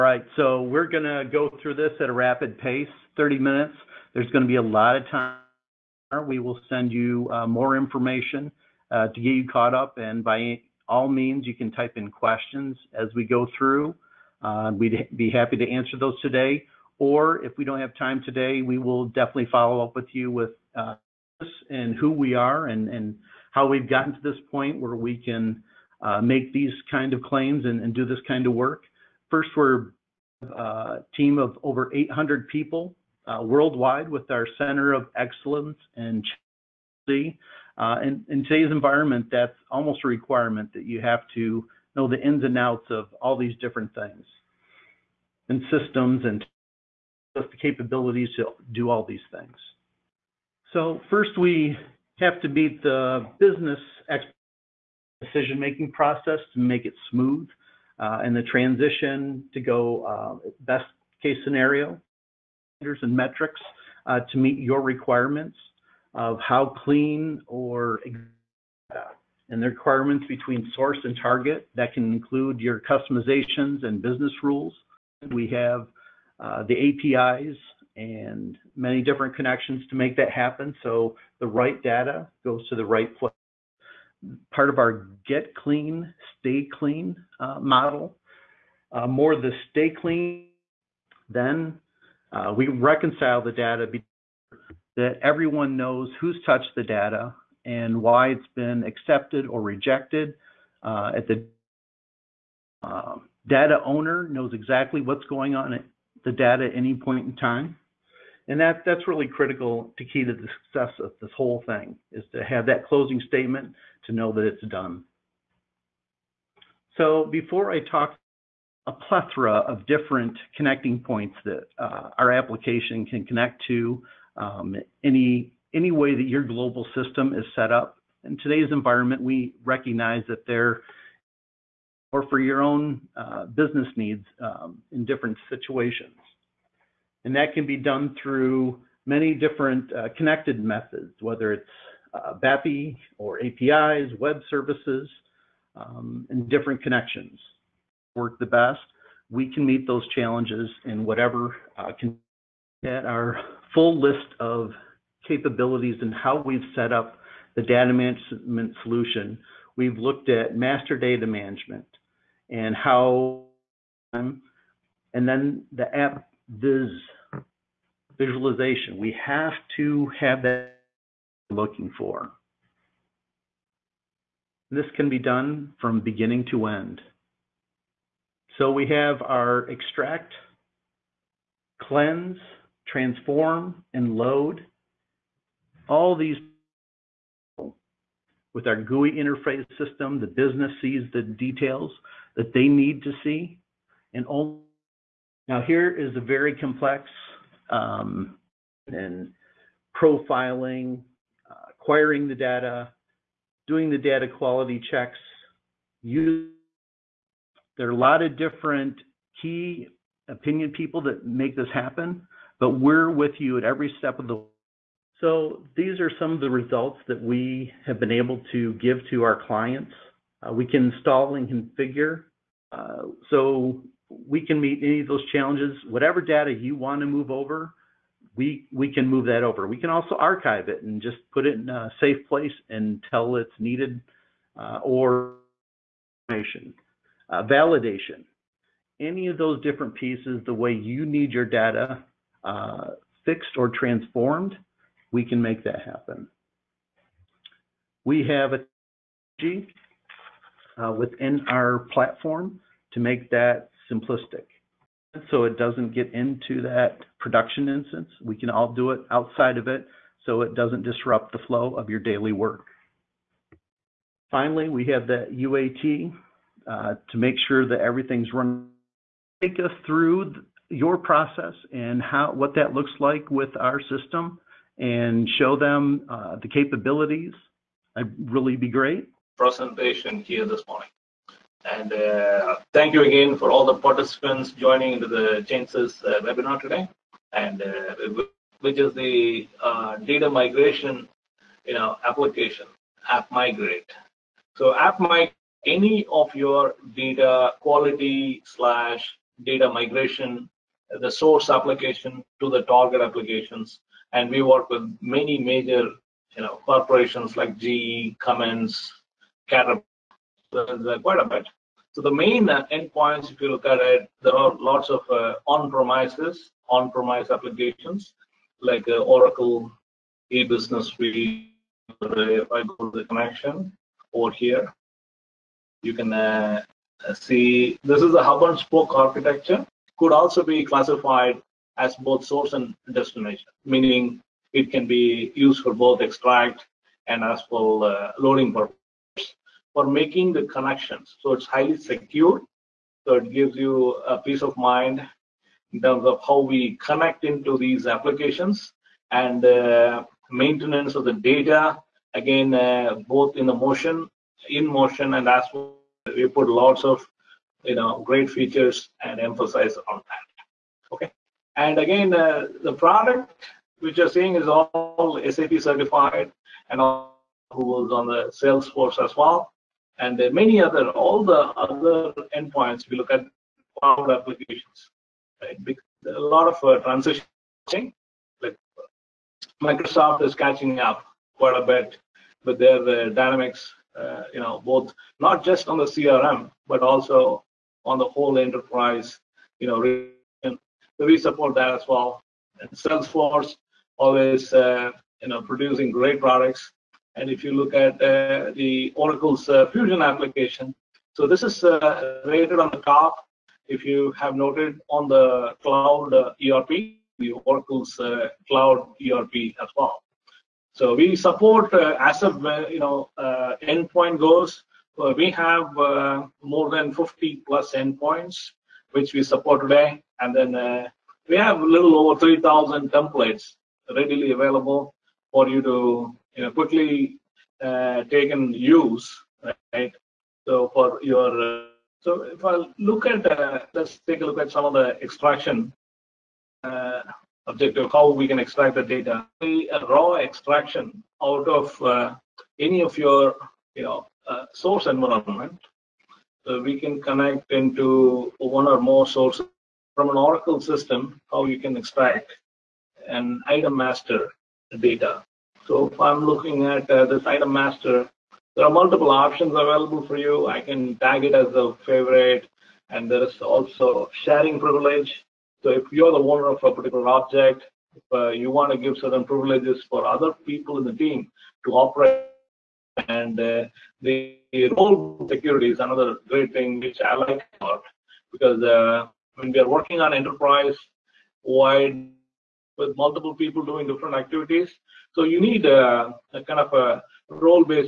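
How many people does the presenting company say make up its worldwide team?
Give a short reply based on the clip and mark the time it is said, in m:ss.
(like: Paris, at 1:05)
over 800, at 0:31.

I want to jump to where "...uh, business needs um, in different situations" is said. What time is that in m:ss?
2:13.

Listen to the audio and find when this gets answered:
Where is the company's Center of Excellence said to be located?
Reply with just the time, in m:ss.
0:37.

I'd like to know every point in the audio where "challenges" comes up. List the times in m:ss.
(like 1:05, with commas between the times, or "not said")
2:30, 3:45.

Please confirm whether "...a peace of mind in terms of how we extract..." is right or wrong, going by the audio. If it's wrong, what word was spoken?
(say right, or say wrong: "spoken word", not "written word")
wrong: "connect", not "extract".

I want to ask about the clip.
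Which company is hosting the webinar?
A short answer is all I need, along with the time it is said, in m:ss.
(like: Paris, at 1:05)
ChainSys, at 4:45.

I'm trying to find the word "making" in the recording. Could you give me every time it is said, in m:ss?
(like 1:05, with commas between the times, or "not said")
0:55, 5:39.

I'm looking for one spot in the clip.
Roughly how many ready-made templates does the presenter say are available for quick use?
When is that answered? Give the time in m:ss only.
7:01.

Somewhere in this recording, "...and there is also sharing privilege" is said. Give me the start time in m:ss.
7:42.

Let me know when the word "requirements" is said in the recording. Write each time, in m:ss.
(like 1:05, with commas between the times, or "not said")
0:40, 1:04, 1:09.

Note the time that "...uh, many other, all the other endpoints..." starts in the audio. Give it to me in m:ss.
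6:10.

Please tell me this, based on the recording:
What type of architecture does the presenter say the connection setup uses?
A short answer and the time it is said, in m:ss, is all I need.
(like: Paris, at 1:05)
hub and spoke, at 5:28.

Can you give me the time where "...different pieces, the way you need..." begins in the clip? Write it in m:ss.
3:59.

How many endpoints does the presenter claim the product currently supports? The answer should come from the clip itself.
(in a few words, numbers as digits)
50 plus.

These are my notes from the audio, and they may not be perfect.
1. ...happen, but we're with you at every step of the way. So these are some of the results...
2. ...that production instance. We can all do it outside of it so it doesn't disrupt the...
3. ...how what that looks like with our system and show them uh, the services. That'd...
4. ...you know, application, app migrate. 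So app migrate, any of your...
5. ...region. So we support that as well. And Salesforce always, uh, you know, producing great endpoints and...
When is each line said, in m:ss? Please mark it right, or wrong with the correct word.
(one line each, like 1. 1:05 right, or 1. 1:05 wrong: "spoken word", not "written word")
1. 3:31 right
2. 4:16 right
3. 4:32 wrong: "capabilities", not "services"
4. 4:51 right
5. 6:29 wrong: "products", not "endpoints".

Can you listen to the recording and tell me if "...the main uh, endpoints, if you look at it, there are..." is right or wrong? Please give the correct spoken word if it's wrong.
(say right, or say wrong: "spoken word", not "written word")
right.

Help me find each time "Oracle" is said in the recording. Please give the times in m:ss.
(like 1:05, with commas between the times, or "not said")
5:18, 6:38, 6:47, 7:30.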